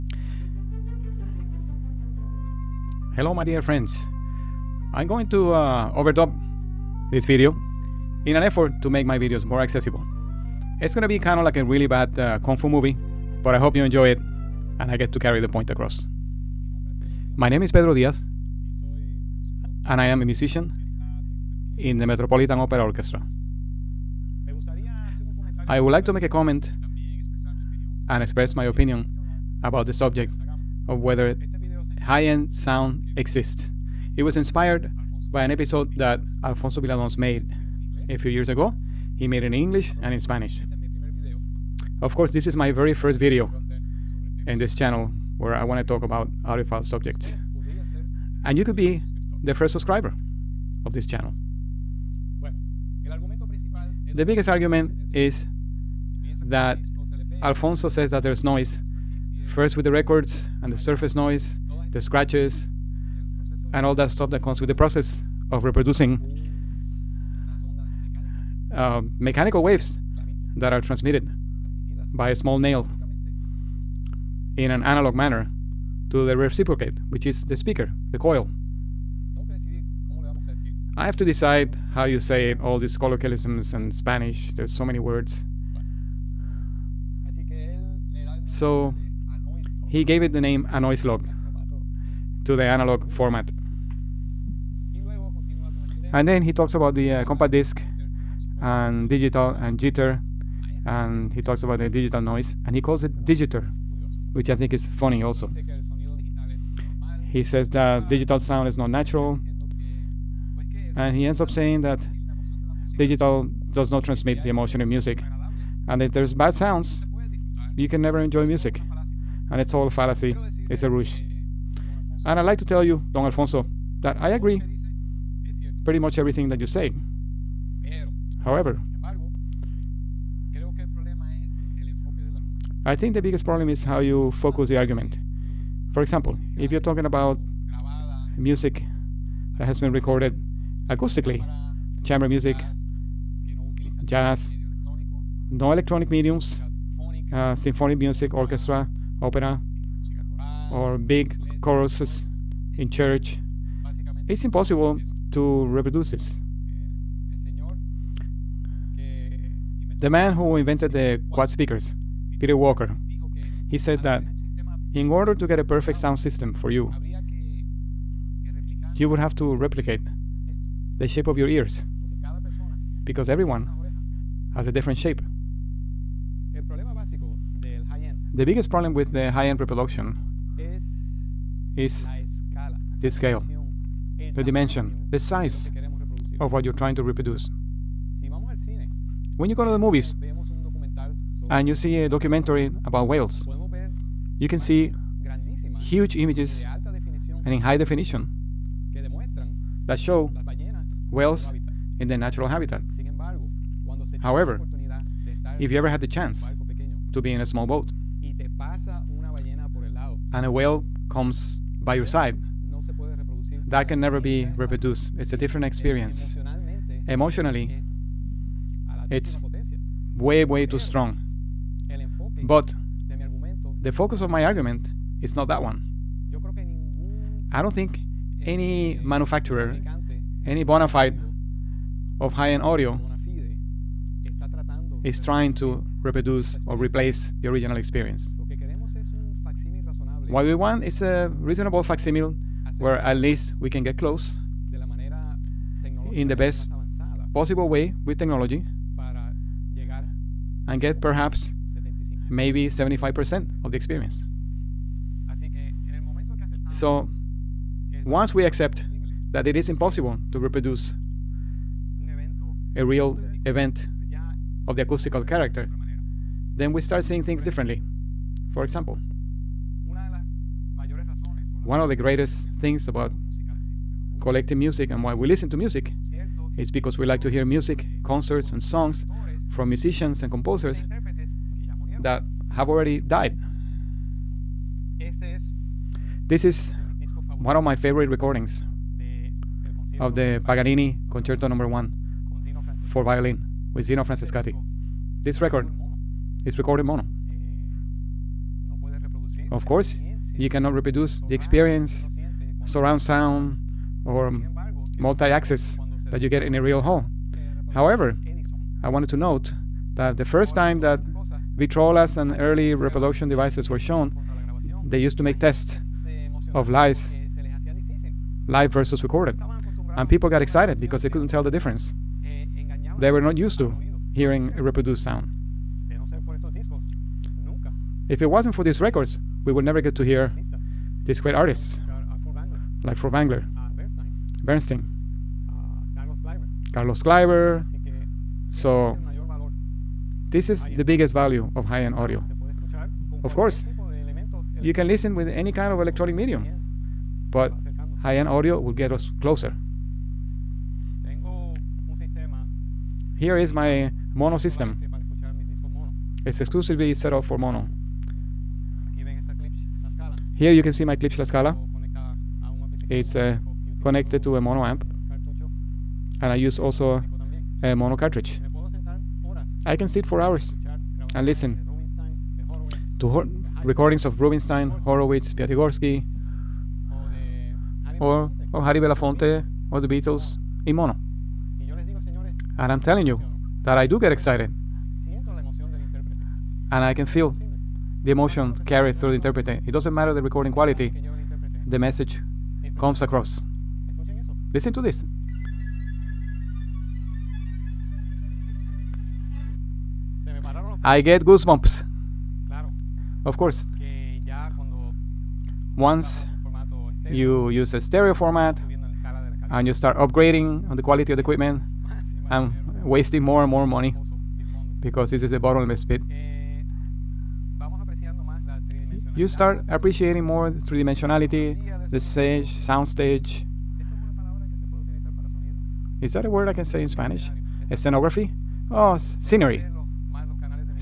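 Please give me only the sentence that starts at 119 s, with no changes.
And it's all a fallacy, it's a ruse.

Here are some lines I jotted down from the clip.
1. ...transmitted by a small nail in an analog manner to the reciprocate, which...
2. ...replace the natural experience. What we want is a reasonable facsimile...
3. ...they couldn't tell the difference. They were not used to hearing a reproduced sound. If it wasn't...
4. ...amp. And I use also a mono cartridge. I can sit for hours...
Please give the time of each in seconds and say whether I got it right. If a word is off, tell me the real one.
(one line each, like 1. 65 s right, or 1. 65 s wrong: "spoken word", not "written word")
1. 70 s right
2. 236 s wrong: "original", not "natural"
3. 321 s right
4. 364 s right.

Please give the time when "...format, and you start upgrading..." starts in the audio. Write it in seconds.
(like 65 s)
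408 s.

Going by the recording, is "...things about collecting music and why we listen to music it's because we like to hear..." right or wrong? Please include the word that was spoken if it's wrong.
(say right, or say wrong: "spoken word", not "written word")
right.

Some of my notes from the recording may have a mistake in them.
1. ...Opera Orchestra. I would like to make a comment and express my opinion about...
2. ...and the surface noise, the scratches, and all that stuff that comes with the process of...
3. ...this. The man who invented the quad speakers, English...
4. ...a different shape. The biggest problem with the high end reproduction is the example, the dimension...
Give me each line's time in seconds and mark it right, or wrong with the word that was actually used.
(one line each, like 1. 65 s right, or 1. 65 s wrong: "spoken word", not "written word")
1. 22 s right
2. 60 s right
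3. 156 s wrong: "Peter", not "English"
4. 174 s wrong: "scale", not "example".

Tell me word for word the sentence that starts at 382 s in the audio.
And I'm telling you that I do get excited and I can feel the emotion carried through the interpreter.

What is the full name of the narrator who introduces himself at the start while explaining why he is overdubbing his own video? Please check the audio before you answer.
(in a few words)
Pedro Diaz.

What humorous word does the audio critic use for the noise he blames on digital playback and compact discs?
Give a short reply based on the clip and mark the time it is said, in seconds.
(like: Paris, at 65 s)
digiter, at 103 s.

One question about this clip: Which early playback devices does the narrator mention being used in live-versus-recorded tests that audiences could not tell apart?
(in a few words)
Victrolas.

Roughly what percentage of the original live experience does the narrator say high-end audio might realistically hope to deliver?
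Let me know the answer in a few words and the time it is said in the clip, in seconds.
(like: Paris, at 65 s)
75%, at 252 s.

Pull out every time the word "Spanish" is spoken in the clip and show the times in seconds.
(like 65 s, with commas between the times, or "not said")
40 s, 83 s, 426 s.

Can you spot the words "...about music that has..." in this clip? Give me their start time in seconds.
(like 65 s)
137 s.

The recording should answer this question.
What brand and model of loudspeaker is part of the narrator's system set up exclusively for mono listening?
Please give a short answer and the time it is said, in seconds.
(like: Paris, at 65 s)
Klipsch La Scala, at 360 s.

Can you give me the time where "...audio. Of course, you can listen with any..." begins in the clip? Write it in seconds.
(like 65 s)
341 s.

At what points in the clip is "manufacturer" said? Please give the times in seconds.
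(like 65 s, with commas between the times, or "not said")
229 s.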